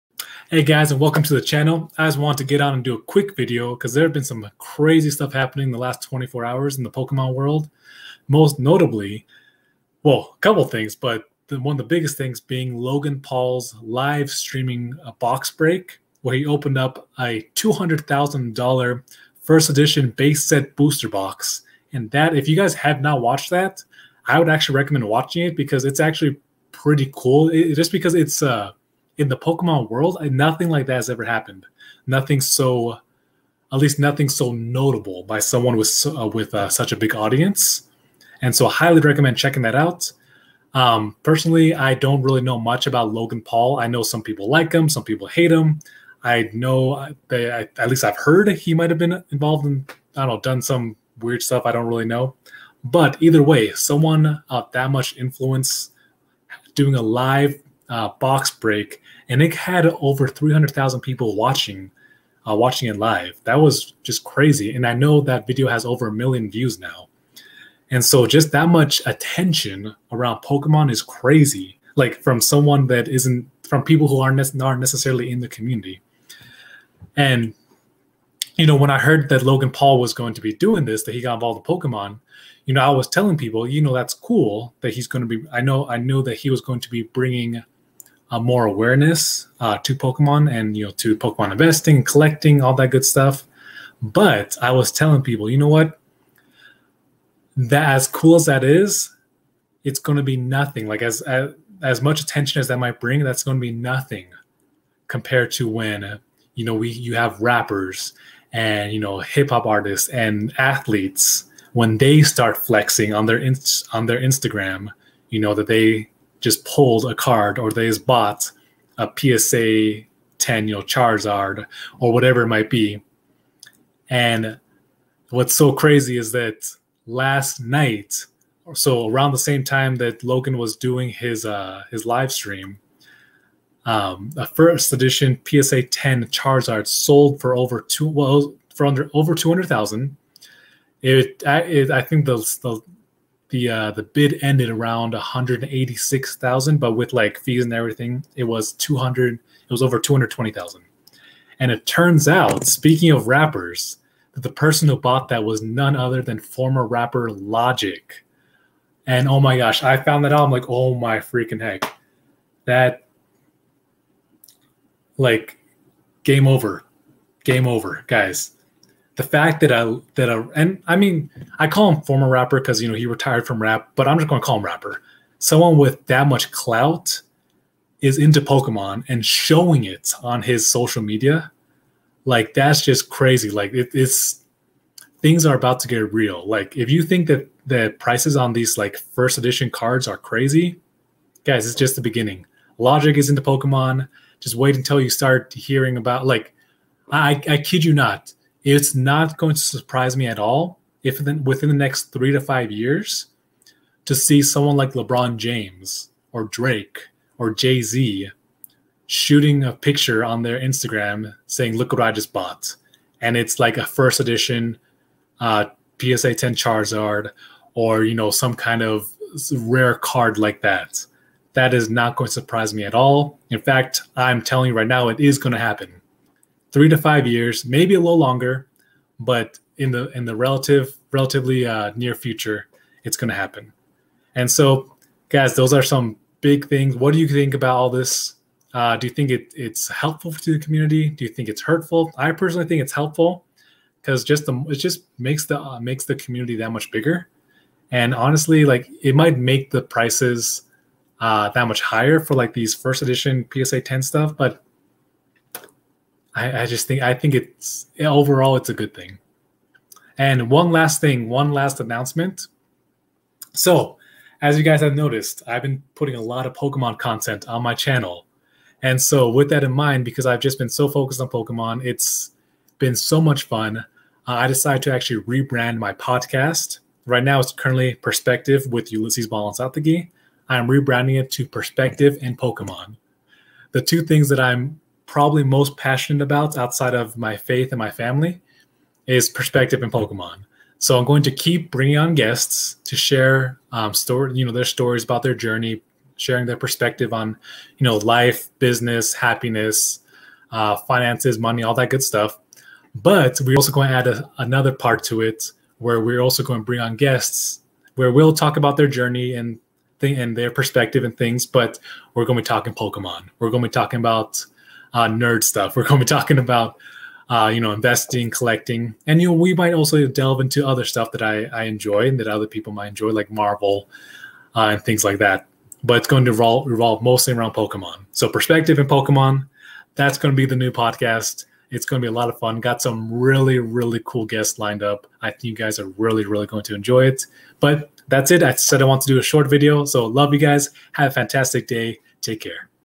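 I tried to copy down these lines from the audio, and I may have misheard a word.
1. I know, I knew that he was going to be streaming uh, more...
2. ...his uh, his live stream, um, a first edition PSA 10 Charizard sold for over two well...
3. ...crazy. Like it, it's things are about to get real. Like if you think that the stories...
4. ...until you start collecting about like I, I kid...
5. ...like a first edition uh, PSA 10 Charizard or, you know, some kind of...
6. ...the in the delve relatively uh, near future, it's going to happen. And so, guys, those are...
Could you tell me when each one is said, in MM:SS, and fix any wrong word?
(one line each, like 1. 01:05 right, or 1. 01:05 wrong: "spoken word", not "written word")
1. 01:25 wrong: "bringing", not "streaming"
2. 02:11 right
3. 03:03 wrong: "prices", not "stories"
4. 03:14 wrong: "hearing", not "collecting"
5. 03:33 right
6. 03:49 wrong: "relative", not "delve".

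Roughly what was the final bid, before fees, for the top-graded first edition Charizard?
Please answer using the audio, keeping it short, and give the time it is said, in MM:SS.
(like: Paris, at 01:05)
186,000, at 02:25.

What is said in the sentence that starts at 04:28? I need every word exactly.
And so, with that in mind, because I've just been so focused on Pokemon, it's been so much fun.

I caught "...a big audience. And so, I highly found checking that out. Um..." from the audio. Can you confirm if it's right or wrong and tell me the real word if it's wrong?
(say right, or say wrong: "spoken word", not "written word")
wrong: "recommend", not "found".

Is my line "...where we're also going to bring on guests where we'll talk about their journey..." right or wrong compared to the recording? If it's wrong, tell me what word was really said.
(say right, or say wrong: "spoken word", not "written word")
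right.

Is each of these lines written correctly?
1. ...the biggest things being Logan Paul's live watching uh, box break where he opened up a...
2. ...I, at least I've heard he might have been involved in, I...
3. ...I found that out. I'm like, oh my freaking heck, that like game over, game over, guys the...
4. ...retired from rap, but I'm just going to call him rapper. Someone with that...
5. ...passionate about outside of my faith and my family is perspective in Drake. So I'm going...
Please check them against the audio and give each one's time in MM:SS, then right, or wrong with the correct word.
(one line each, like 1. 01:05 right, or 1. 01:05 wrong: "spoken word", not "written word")
1. 00:11 wrong: "streaming", not "watching"
2. 00:47 right
3. 02:39 right
4. 02:53 right
5. 04:45 wrong: "Pokemon", not "Drake".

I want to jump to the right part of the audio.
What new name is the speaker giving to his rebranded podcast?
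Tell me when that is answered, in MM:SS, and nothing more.
04:41.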